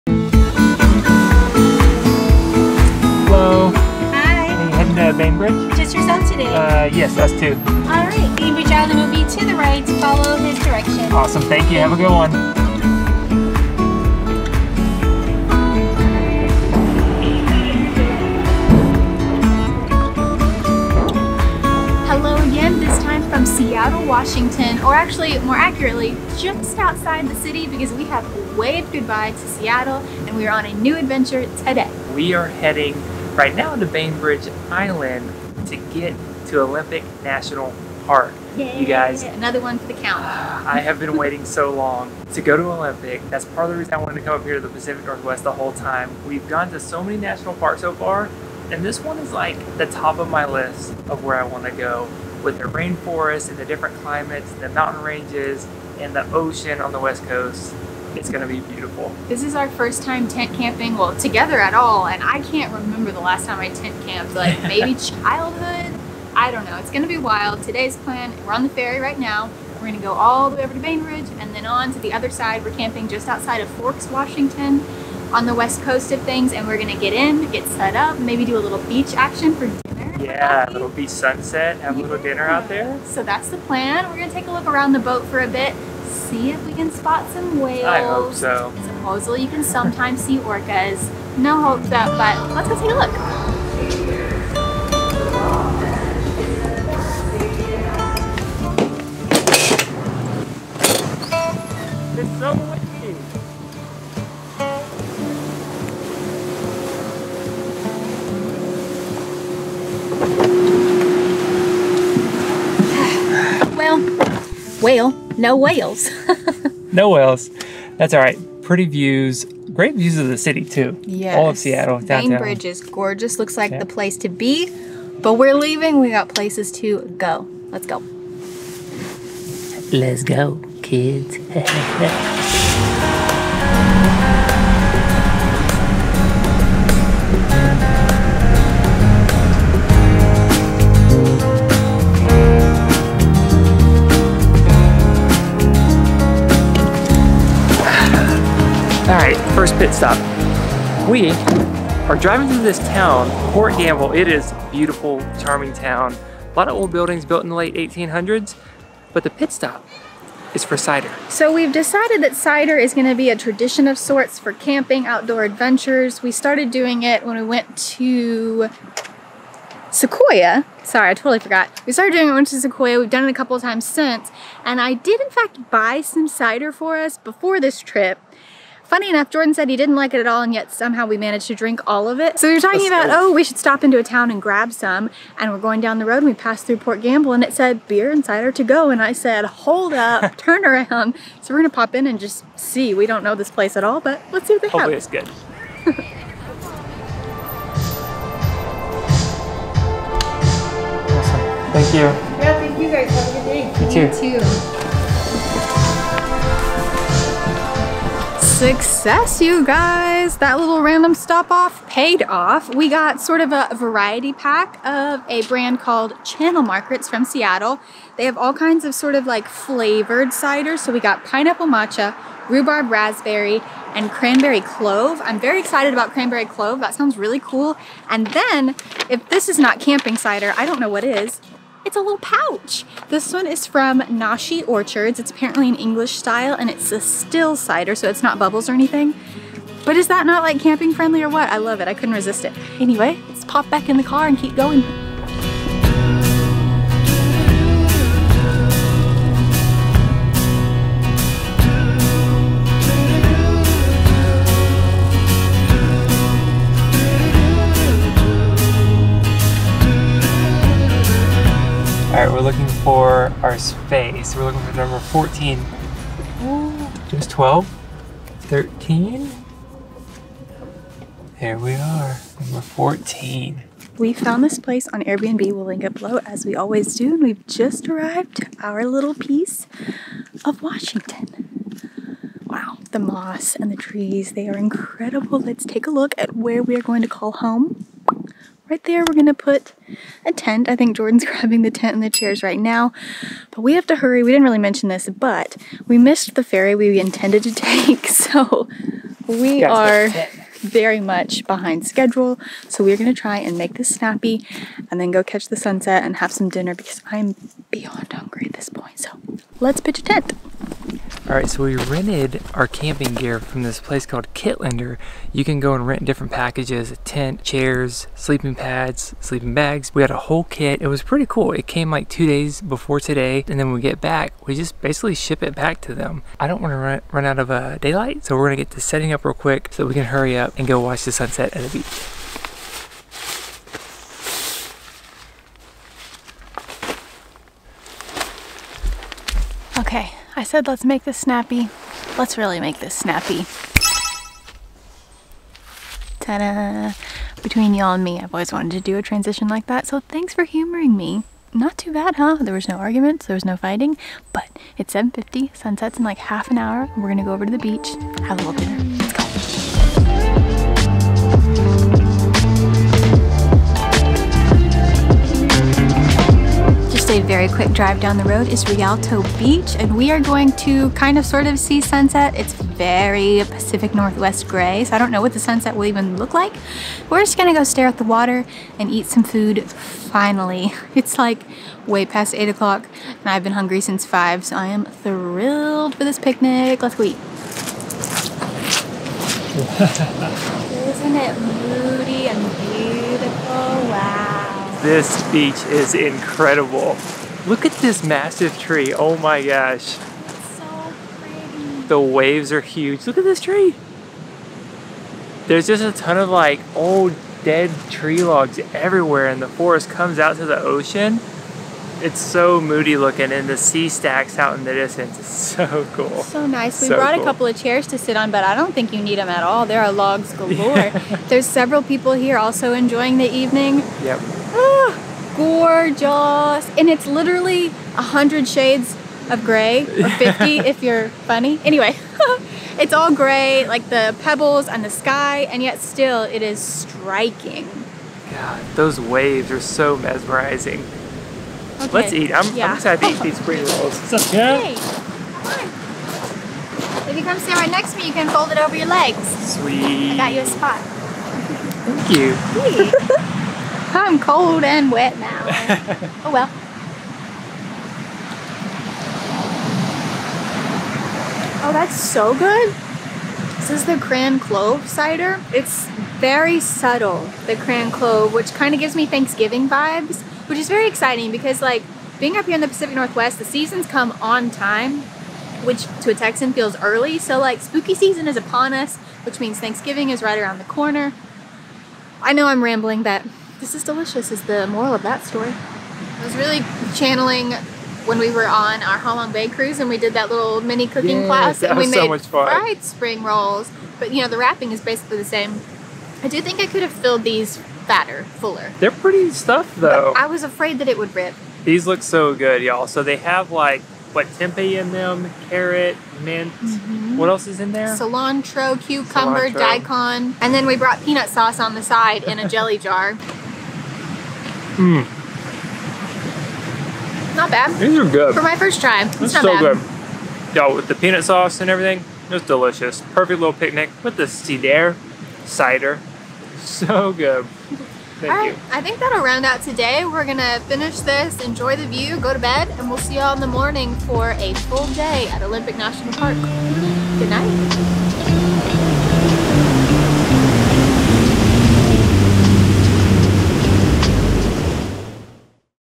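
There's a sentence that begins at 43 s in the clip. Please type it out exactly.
That's part of the reason I wanted to come up here to the Pacific Northwest the whole time.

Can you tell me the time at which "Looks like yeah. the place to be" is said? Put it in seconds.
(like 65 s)
123 s.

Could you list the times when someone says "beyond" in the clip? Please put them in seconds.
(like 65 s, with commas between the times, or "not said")
307 s.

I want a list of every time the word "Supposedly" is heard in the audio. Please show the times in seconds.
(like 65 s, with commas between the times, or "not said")
88 s.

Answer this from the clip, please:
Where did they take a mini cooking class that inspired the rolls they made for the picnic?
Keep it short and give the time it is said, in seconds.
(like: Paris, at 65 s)
Halong Bay, at 488 s.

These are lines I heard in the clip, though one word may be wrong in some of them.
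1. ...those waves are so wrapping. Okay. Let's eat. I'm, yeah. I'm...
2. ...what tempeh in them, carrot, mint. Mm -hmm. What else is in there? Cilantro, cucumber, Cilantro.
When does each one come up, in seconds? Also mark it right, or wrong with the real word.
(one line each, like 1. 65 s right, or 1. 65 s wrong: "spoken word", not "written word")
1. 438 s wrong: "mesmerizing", not "wrapping"
2. 504 s right.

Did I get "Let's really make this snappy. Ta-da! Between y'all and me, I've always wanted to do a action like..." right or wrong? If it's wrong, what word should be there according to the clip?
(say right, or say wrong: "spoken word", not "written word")
wrong: "transition", not "action".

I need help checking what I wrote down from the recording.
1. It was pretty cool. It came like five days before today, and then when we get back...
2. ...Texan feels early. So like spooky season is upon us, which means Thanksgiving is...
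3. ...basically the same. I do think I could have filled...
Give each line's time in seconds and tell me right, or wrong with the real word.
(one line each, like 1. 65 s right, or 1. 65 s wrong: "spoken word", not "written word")
1. 320 s wrong: "two", not "five"
2. 476 s right
3. 494 s right.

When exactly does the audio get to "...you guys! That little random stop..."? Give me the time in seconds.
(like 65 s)
209 s.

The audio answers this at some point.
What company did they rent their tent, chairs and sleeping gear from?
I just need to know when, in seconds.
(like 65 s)
314 s.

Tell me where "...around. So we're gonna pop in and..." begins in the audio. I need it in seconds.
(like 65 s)
190 s.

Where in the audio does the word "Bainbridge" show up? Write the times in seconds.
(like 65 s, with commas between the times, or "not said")
33 s, 70 s.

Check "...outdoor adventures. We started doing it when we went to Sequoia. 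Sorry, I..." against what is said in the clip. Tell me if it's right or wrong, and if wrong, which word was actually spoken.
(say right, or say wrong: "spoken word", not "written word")
right.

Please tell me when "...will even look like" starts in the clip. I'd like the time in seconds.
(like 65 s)
375 s.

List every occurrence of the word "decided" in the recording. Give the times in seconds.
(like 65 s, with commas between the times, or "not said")
161 s.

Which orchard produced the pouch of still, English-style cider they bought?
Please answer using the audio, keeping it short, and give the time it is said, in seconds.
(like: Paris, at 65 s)
Nashi Orchards, at 234 s.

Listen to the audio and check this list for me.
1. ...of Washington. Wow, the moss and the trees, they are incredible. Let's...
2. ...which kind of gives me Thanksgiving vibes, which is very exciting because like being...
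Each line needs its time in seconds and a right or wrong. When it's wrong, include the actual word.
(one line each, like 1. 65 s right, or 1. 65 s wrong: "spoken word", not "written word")
1. 280 s right
2. 468 s right.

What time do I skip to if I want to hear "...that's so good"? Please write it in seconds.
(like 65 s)
461 s.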